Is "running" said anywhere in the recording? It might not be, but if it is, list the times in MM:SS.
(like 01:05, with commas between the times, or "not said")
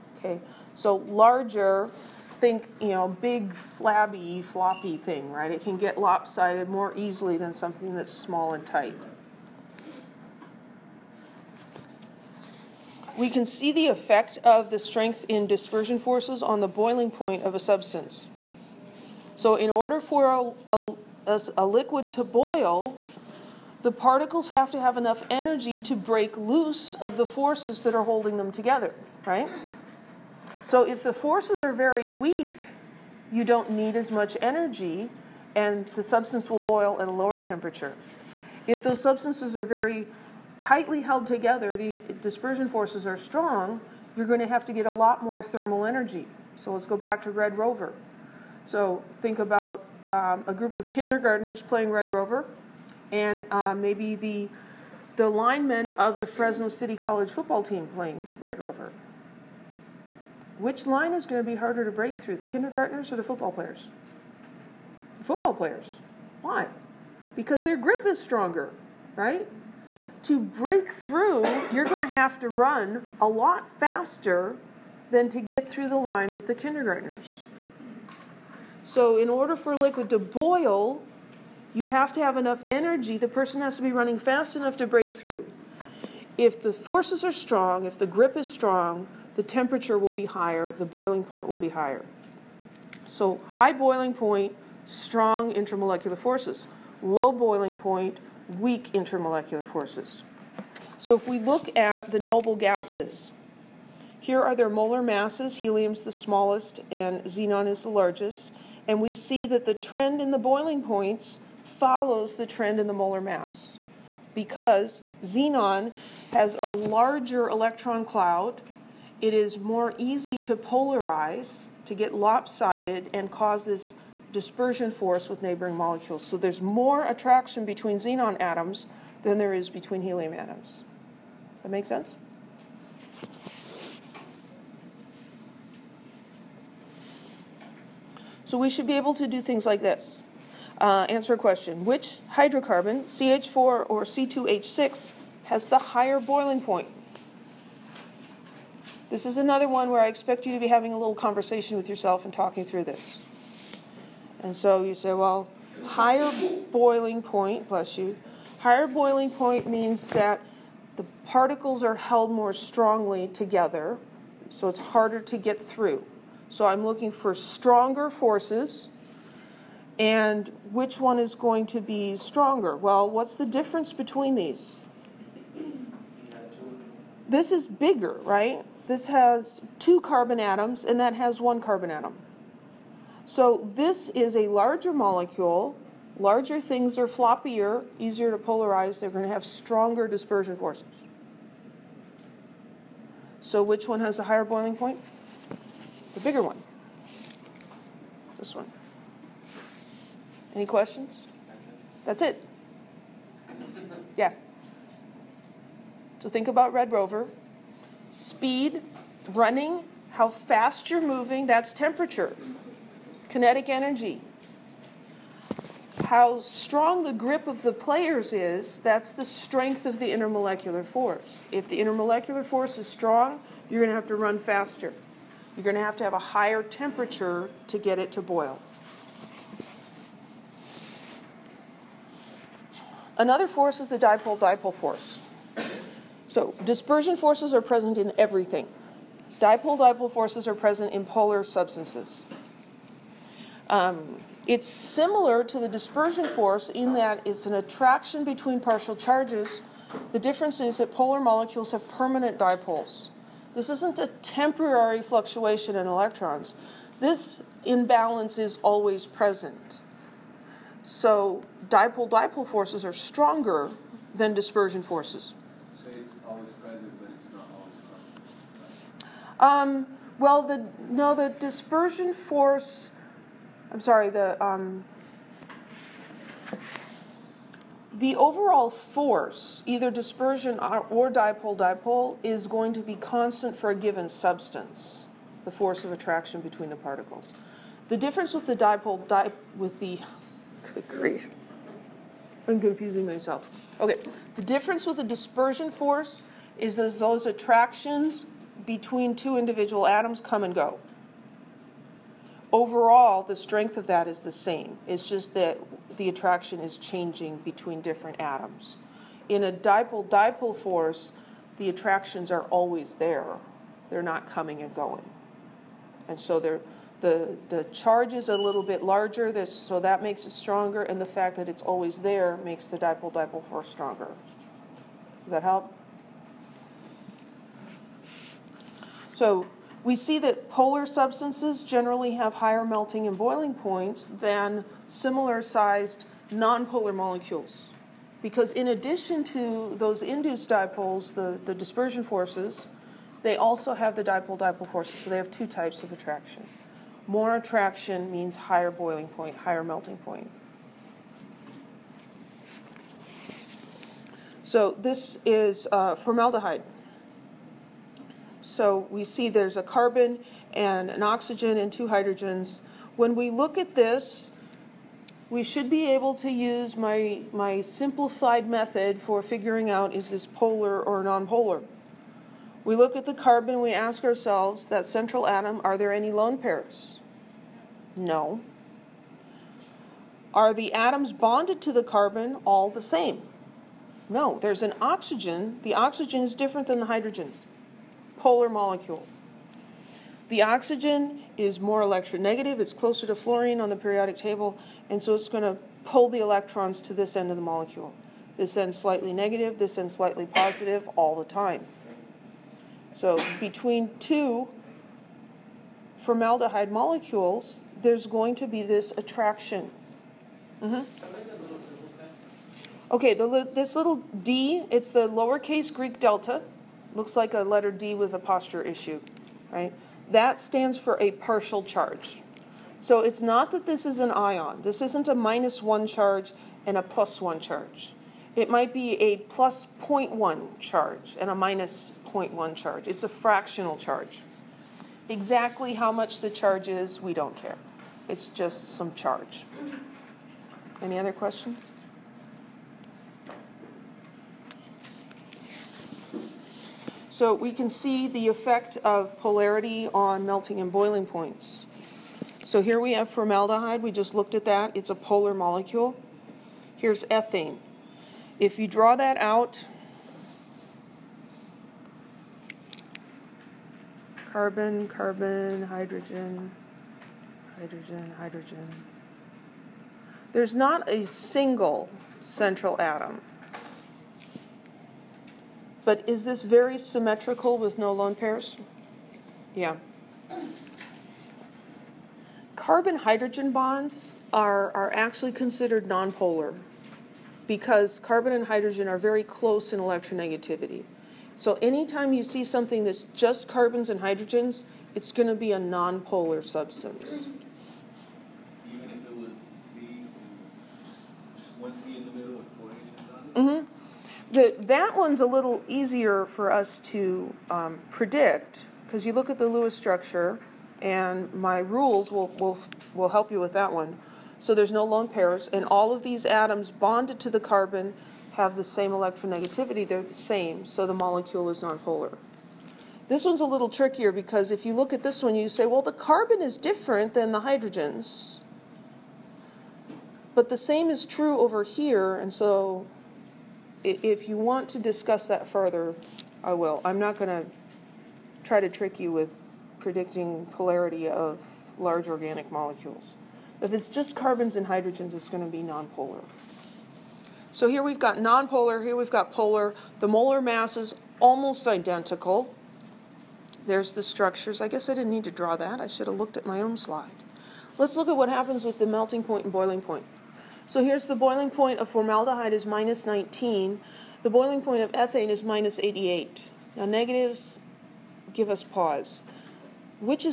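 01:23, 03:29.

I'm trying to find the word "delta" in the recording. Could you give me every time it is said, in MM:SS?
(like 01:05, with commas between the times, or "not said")
06:55.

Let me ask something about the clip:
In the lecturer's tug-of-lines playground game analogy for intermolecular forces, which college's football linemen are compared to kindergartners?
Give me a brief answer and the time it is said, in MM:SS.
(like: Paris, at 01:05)
Fresno City College, at 00:56.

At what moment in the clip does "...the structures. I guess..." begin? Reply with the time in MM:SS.
09:13.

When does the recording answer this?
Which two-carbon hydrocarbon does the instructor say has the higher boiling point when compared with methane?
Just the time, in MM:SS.
02:24.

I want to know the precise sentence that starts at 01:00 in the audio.
Which line is going to be harder to break through, the kindergartners or the football players?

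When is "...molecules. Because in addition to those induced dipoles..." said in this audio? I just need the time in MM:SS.
05:36.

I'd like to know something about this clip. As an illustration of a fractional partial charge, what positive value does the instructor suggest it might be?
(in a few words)
+0.1.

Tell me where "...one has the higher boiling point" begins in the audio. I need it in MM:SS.
03:13.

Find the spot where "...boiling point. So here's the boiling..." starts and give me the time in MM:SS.
09:19.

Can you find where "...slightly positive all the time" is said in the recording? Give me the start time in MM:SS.
06:39.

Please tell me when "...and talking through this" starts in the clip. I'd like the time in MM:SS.
02:32.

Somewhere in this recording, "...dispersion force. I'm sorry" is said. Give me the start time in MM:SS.
04:31.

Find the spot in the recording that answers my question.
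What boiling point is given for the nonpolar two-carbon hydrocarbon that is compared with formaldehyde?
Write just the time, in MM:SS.
09:25.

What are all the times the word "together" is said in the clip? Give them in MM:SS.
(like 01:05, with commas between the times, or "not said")
00:28, 00:41, 02:43.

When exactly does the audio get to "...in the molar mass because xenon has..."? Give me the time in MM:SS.
01:52.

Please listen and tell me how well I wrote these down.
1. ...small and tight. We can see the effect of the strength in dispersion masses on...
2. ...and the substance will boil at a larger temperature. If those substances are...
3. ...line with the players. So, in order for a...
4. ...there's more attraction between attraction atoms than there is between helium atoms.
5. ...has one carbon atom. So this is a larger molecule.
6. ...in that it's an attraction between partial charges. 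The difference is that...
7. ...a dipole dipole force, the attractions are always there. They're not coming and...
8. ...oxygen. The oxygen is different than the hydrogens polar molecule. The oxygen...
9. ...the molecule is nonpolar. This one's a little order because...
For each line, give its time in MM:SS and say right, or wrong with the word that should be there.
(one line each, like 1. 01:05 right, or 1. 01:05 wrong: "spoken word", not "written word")
1. 00:08 wrong: "forces", not "masses"
2. 00:35 wrong: "lower", not "larger"
3. 01:15 wrong: "kindergartners", not "players"
4. 02:06 wrong: "xenon", not "attraction"
5. 03:01 right
6. 04:06 right
7. 05:09 right
8. 06:24 right
9. 08:40 wrong: "trickier", not "order".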